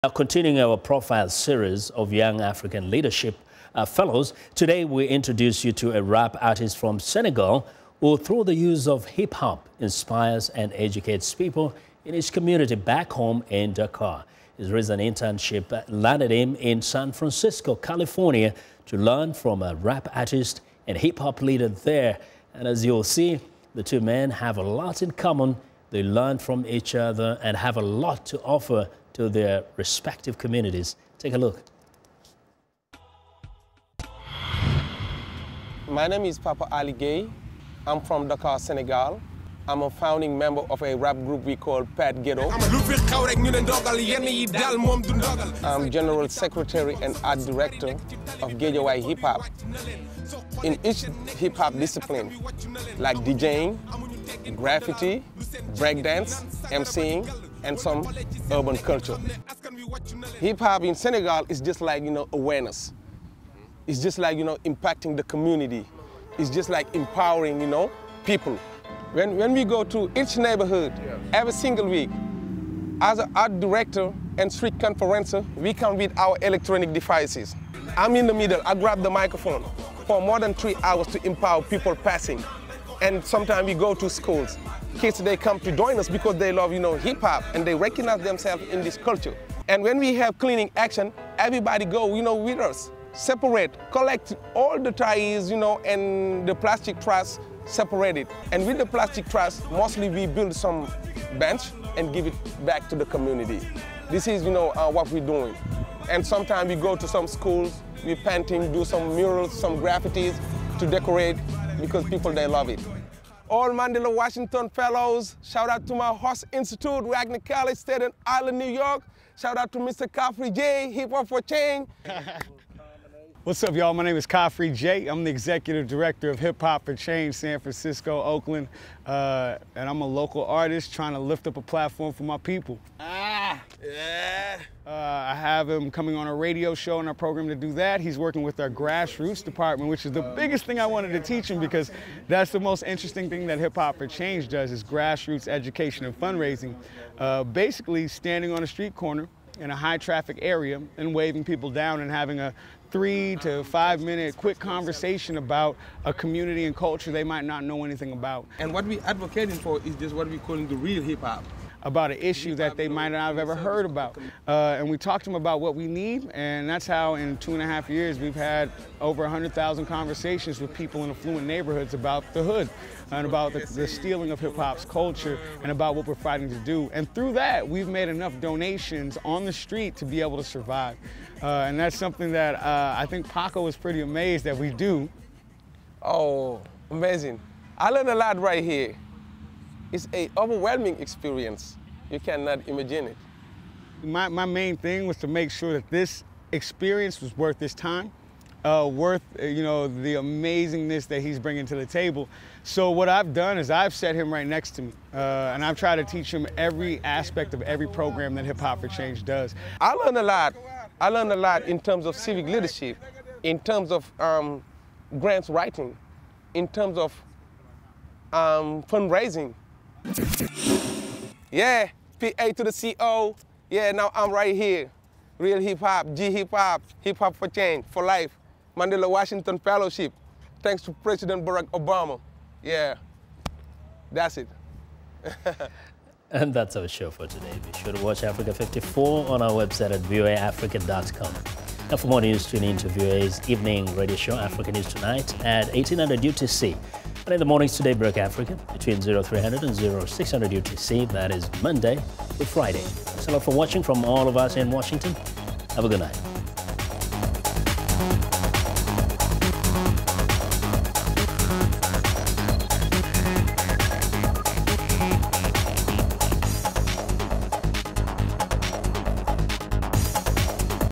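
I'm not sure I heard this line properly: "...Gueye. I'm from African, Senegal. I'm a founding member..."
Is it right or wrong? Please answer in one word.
wrong.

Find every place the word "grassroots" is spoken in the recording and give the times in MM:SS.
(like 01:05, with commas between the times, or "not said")
02:18, 02:24.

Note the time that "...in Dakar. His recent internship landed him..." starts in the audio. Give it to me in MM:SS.
00:13.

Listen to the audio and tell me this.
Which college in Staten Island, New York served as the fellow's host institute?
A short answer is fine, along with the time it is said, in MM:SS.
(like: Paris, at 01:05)
Wagner College, at 01:57.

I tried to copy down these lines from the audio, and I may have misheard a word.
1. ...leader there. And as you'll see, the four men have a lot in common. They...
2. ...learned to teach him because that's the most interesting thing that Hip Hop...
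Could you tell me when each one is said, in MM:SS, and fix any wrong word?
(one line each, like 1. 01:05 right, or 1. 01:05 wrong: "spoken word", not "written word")
1. 00:21 wrong: "two", not "four"
2. 02:20 wrong: "wanted", not "learned".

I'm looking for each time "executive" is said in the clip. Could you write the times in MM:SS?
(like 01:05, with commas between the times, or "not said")
02:05.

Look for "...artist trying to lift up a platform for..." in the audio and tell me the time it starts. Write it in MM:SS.
02:10.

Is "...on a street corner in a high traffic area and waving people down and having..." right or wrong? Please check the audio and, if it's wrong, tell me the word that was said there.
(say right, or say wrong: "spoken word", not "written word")
right.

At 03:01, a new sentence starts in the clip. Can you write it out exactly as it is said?
Uh, and that's something that uh, I think Paco is pretty amazed that we do.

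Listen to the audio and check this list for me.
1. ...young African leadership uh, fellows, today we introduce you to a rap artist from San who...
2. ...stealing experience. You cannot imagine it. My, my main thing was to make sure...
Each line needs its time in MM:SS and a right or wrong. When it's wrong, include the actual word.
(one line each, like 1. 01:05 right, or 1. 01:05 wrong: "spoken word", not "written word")
1. 00:02 wrong: "Senegal", not "San"
2. 03:10 wrong: "overwhelming", not "stealing".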